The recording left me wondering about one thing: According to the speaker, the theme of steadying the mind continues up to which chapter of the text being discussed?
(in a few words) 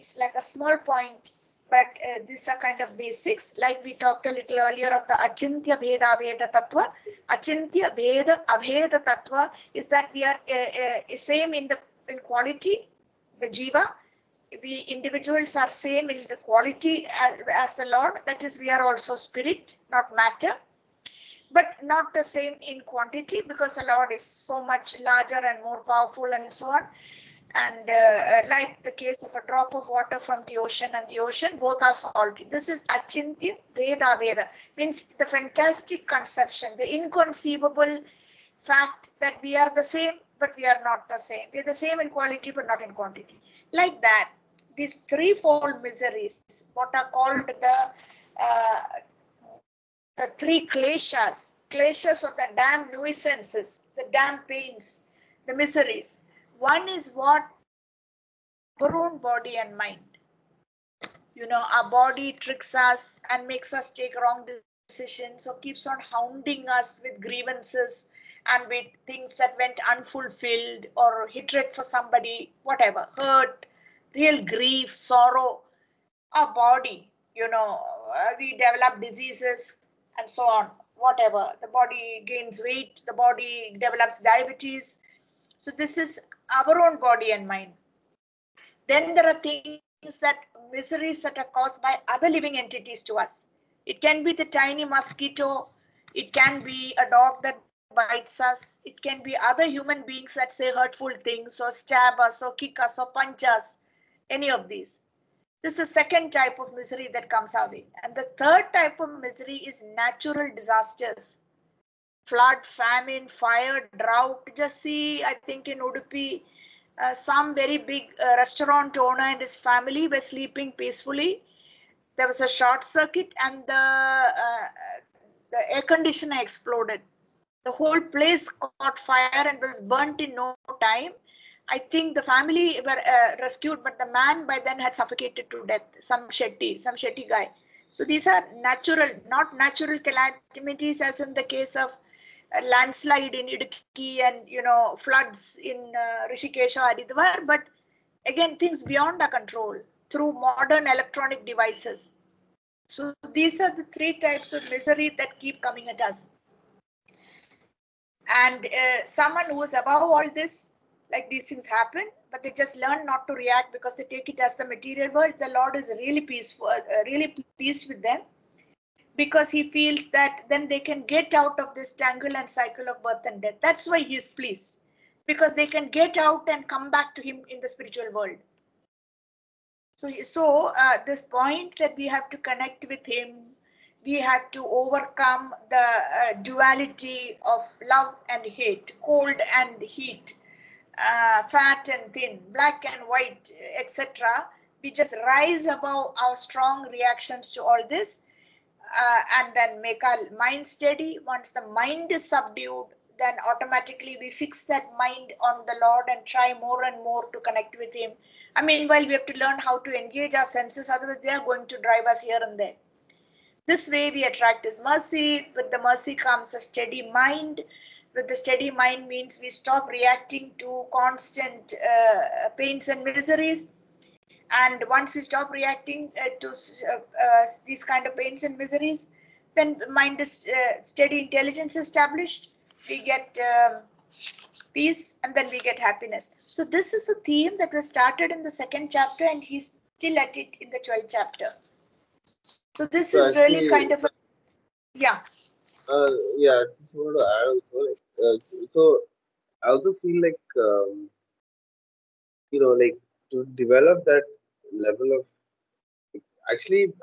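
12th chapter.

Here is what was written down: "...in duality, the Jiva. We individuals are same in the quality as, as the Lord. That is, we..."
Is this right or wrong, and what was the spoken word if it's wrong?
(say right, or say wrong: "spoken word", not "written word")
wrong: "quality", not "duality".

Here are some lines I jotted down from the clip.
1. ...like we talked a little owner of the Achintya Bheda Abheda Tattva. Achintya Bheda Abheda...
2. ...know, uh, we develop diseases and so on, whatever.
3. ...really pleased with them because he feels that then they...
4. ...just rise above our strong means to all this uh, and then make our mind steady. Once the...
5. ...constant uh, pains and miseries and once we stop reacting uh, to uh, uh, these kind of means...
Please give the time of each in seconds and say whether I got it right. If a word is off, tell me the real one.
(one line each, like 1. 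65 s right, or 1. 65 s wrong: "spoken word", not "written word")
1. 3 s wrong: "earlier", not "owner"
2. 77 s right
3. 167 s right
4. 194 s wrong: "reactions", not "means"
5. 220 s wrong: "pains", not "means".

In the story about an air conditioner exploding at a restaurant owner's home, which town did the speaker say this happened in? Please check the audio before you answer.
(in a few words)
Udupi.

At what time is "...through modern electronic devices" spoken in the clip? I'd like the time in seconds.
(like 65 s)
150 s.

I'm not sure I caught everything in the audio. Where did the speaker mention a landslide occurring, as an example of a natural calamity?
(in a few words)
Idukki.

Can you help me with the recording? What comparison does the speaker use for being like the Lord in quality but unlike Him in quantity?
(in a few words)
A drop of water from the ocean.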